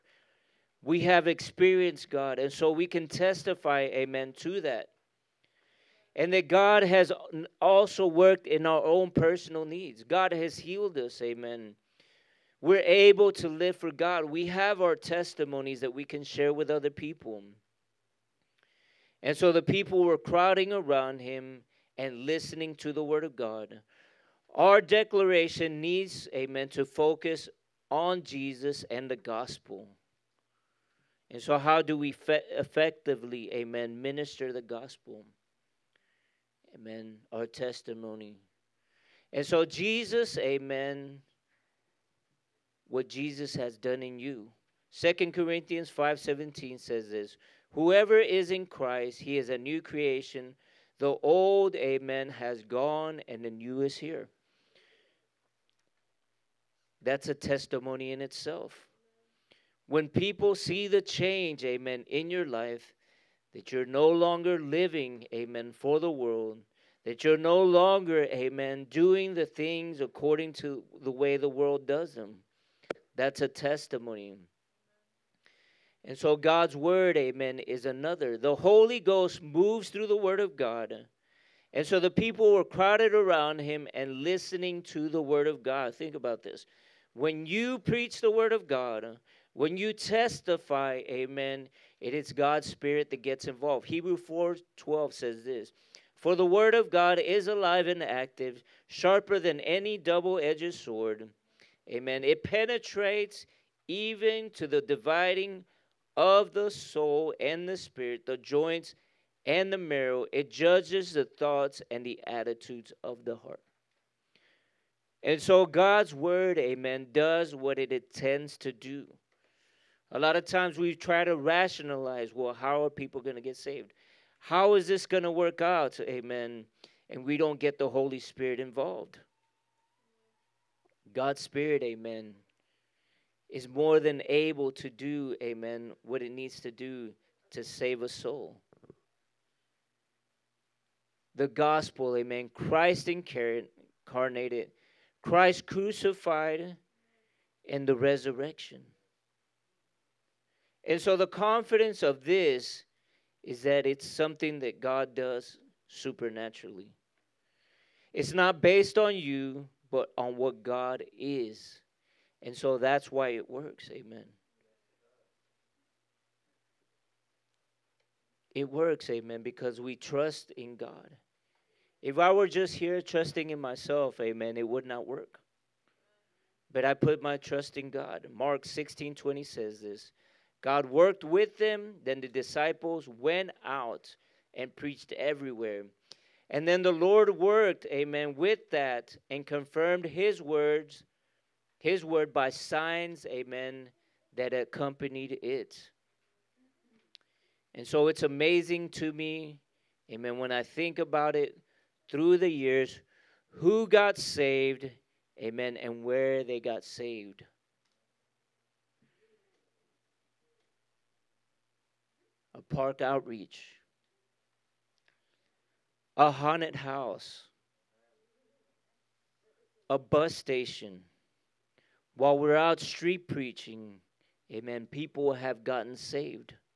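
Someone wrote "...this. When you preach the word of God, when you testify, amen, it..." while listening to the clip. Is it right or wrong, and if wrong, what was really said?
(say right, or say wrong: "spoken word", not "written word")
right.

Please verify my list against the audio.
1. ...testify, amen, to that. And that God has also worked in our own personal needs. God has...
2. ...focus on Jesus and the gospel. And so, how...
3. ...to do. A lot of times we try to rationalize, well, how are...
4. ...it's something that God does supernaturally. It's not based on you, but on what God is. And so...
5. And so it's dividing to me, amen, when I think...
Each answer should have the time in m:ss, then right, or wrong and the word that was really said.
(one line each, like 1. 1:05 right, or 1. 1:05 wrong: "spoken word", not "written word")
1. 0:03 right
2. 0:26 right
3. 1:58 right
4. 2:33 right
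5. 3:17 wrong: "amazing", not "dividing".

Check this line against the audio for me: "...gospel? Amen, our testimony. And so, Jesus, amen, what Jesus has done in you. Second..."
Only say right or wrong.
right.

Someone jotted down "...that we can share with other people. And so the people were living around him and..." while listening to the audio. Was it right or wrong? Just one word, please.
wrong.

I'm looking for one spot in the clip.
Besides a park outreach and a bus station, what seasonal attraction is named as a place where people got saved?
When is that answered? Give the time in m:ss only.
3:36.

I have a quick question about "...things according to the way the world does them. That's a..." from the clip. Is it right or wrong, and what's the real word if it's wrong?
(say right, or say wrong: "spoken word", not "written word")
right.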